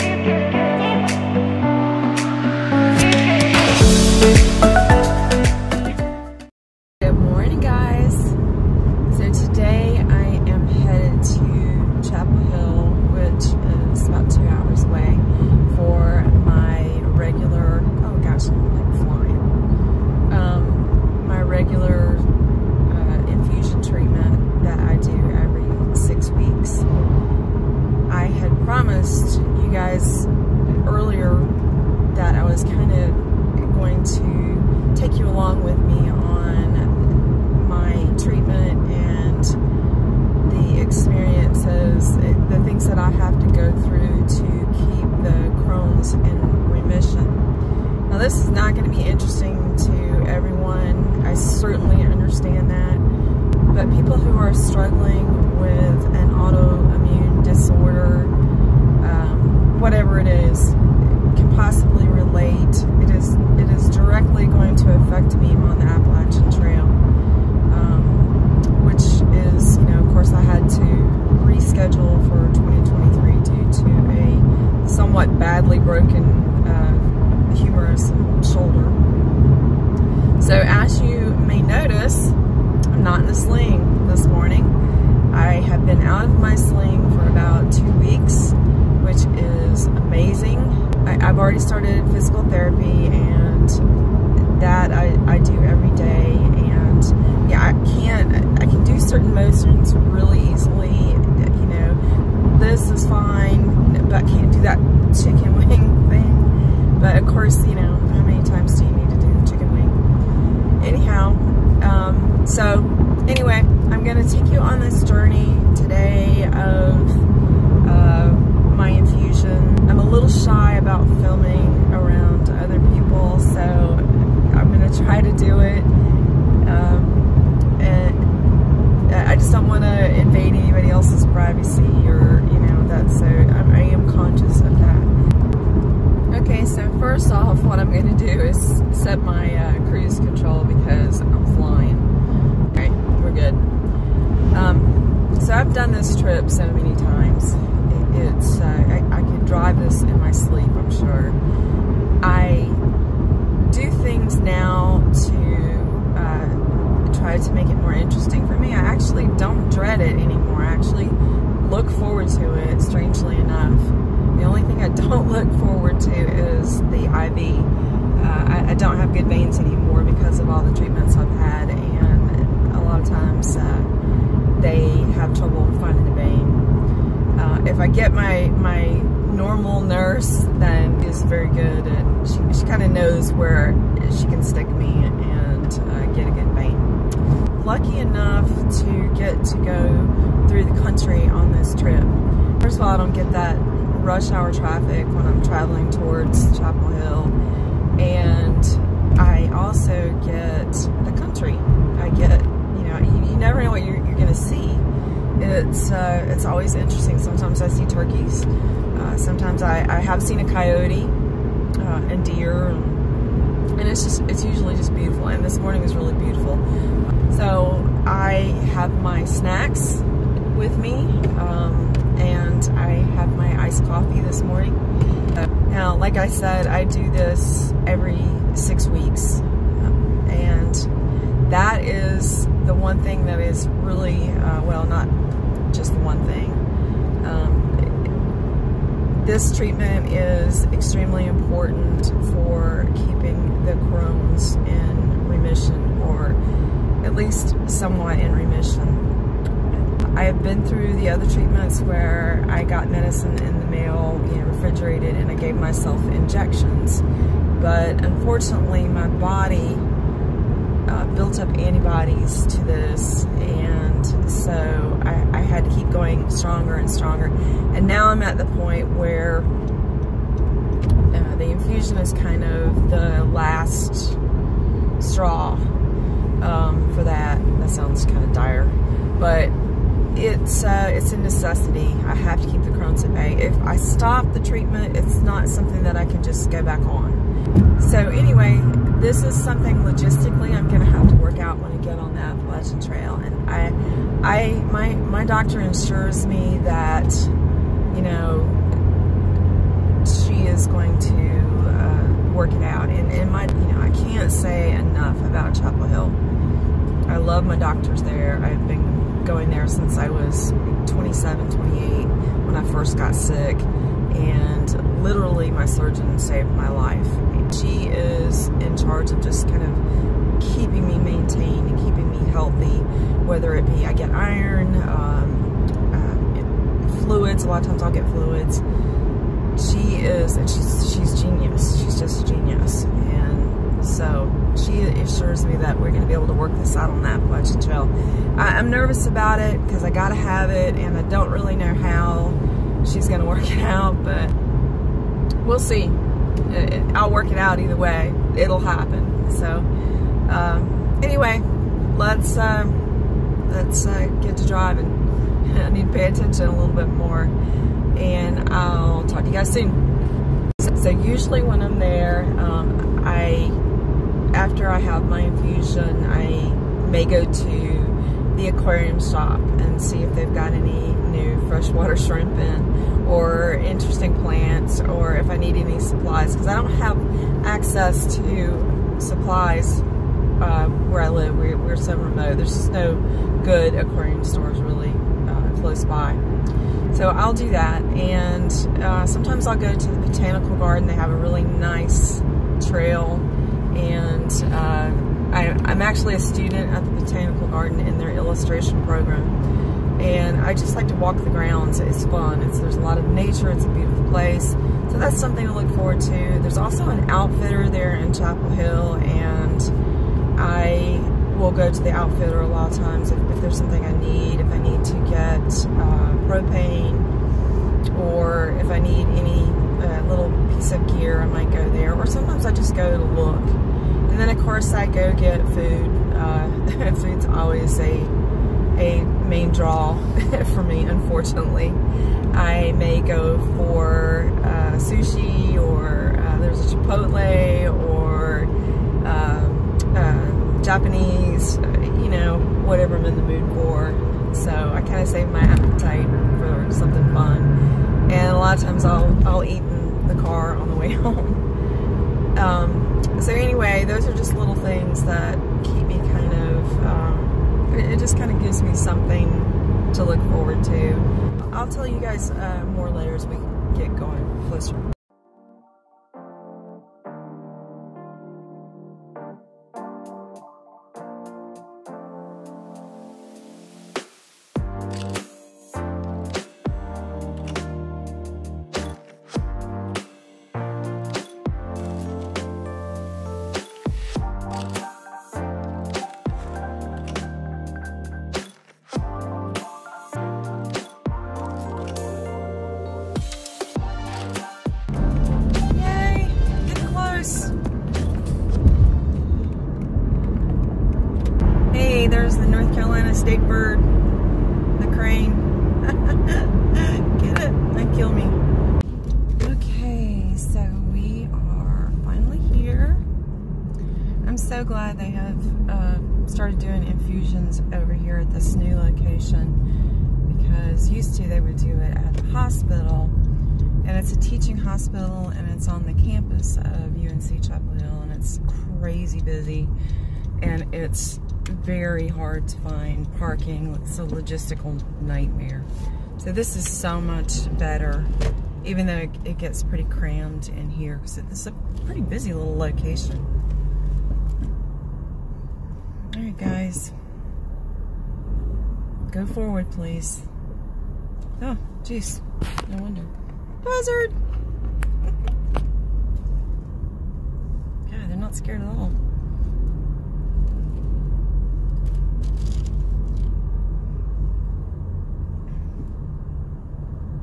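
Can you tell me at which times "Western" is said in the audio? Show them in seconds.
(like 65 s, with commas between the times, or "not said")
not said.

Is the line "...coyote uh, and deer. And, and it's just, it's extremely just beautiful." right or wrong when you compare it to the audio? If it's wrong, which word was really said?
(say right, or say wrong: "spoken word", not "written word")
wrong: "usually", not "extremely".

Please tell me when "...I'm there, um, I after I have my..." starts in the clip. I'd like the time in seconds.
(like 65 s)
361 s.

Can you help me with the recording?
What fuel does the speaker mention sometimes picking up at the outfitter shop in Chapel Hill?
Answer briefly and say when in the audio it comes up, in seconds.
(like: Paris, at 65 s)
propane, at 416 s.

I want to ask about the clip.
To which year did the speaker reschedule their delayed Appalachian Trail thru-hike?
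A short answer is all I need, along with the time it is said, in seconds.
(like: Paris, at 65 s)
2023, at 72 s.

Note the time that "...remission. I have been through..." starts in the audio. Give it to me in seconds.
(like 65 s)
248 s.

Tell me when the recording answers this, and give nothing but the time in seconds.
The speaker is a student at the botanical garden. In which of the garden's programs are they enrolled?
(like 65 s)
398 s.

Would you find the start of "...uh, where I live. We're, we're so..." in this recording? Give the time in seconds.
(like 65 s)
379 s.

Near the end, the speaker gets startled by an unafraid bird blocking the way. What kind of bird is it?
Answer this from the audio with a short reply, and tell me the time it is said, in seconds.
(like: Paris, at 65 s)
buzzard, at 553 s.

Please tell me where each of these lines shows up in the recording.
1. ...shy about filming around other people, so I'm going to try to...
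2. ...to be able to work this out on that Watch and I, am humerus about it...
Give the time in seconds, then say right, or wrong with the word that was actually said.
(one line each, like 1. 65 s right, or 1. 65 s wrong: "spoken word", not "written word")
1. 120 s right
2. 336 s wrong: "nervous", not "humerus".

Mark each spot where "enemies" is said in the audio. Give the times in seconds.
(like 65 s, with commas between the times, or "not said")
not said.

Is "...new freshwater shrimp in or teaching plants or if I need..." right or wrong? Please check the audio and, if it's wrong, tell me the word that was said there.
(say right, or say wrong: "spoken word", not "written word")
wrong: "interesting", not "teaching".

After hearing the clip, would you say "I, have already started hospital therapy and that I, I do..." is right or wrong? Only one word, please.
wrong.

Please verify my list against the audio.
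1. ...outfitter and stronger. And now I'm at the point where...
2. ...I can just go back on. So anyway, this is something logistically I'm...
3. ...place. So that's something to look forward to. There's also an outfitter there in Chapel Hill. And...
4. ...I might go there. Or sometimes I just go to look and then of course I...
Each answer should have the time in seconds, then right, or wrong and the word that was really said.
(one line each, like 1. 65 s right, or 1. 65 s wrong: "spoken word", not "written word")
1. 266 s wrong: "stronger", not "outfitter"
2. 285 s right
3. 404 s right
4. 421 s right.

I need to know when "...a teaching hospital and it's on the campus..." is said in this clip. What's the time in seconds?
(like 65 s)
524 s.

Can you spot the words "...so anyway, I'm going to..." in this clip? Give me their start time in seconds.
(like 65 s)
112 s.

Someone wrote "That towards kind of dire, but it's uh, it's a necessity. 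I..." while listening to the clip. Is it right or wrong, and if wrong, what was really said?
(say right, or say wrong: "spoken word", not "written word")
wrong: "sounds", not "towards".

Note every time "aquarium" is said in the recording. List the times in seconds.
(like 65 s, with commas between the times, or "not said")
368 s, 383 s.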